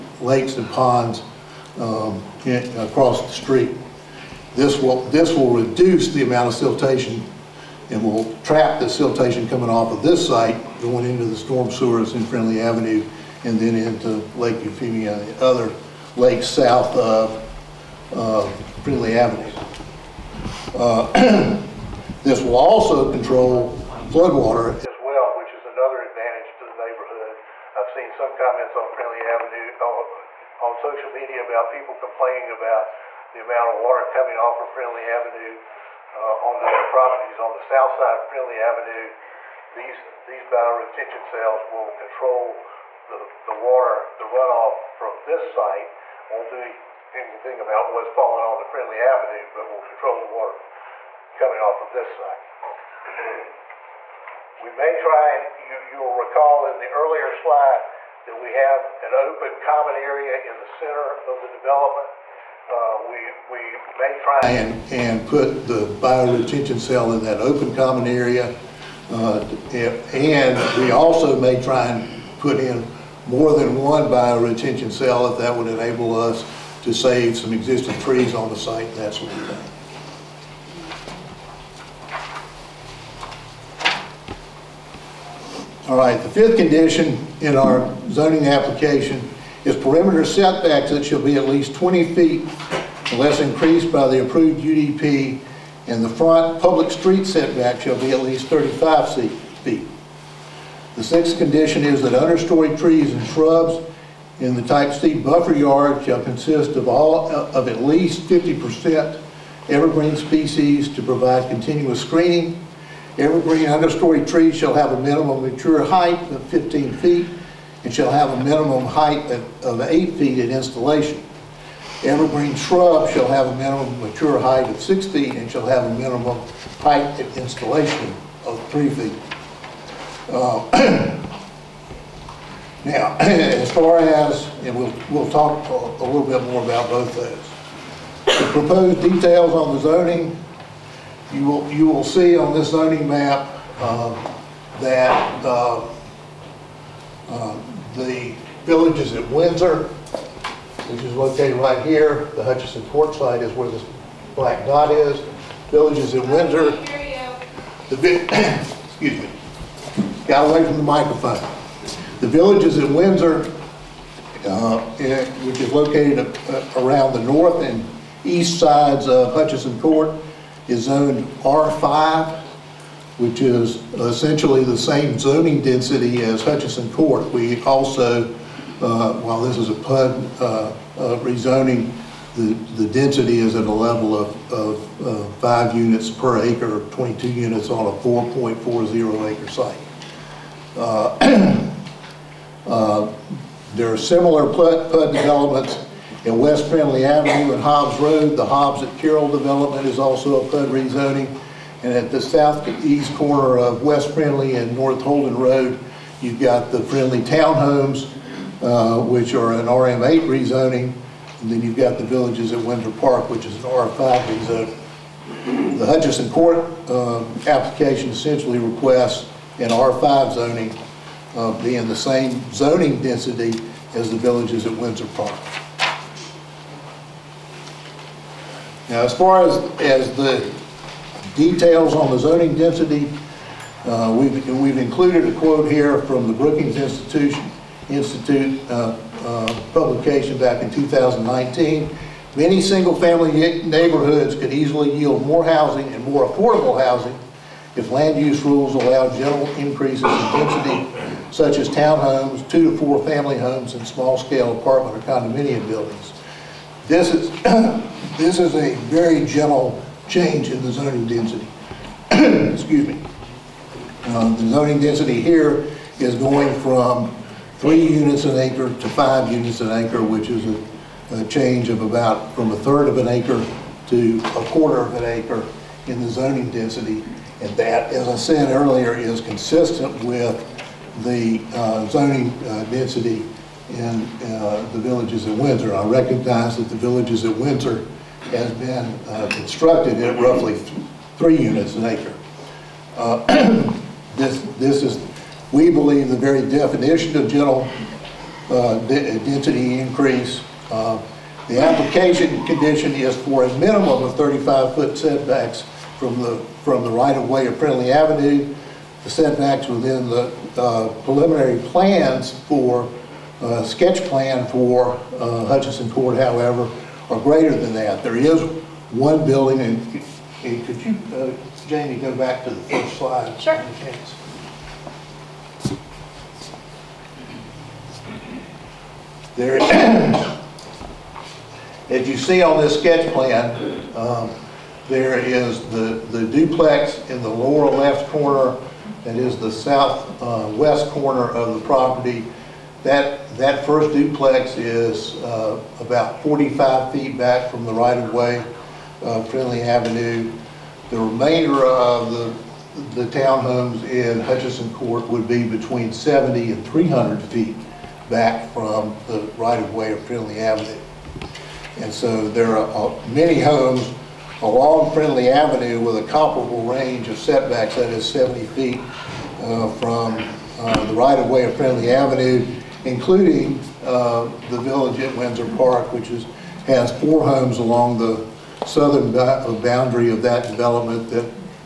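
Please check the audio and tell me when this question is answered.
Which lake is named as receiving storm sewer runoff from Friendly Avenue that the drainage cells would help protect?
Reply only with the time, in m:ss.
0:14.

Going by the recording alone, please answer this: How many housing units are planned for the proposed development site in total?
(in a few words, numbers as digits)
22.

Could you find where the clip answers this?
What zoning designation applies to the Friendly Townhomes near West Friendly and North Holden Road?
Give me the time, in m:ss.
3:29.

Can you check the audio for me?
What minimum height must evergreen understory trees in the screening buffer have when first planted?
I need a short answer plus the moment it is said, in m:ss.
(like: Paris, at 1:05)
8 feet, at 1:59.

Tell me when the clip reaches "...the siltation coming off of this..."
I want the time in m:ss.
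0:08.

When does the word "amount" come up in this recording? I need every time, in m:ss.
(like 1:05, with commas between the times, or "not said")
0:06, 0:33.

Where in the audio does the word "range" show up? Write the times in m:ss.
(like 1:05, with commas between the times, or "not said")
6:06.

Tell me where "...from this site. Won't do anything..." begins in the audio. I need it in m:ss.
0:44.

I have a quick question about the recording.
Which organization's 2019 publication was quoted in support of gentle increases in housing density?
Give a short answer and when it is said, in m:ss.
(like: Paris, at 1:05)
Brookings Institution, at 3:56.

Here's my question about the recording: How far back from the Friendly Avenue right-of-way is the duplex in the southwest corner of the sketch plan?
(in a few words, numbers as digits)
45 feet.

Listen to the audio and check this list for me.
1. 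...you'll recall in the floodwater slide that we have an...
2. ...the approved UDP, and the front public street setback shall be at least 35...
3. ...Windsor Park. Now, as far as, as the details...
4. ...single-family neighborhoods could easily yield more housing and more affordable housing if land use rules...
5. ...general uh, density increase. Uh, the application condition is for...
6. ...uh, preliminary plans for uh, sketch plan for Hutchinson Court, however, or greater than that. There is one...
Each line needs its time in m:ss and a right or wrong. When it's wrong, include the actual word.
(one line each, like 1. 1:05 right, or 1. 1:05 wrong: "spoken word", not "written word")
1. 0:55 wrong: "earlier", not "floodwater"
2. 1:34 right
3. 3:44 right
4. 4:02 right
5. 4:57 right
6. 5:10 right.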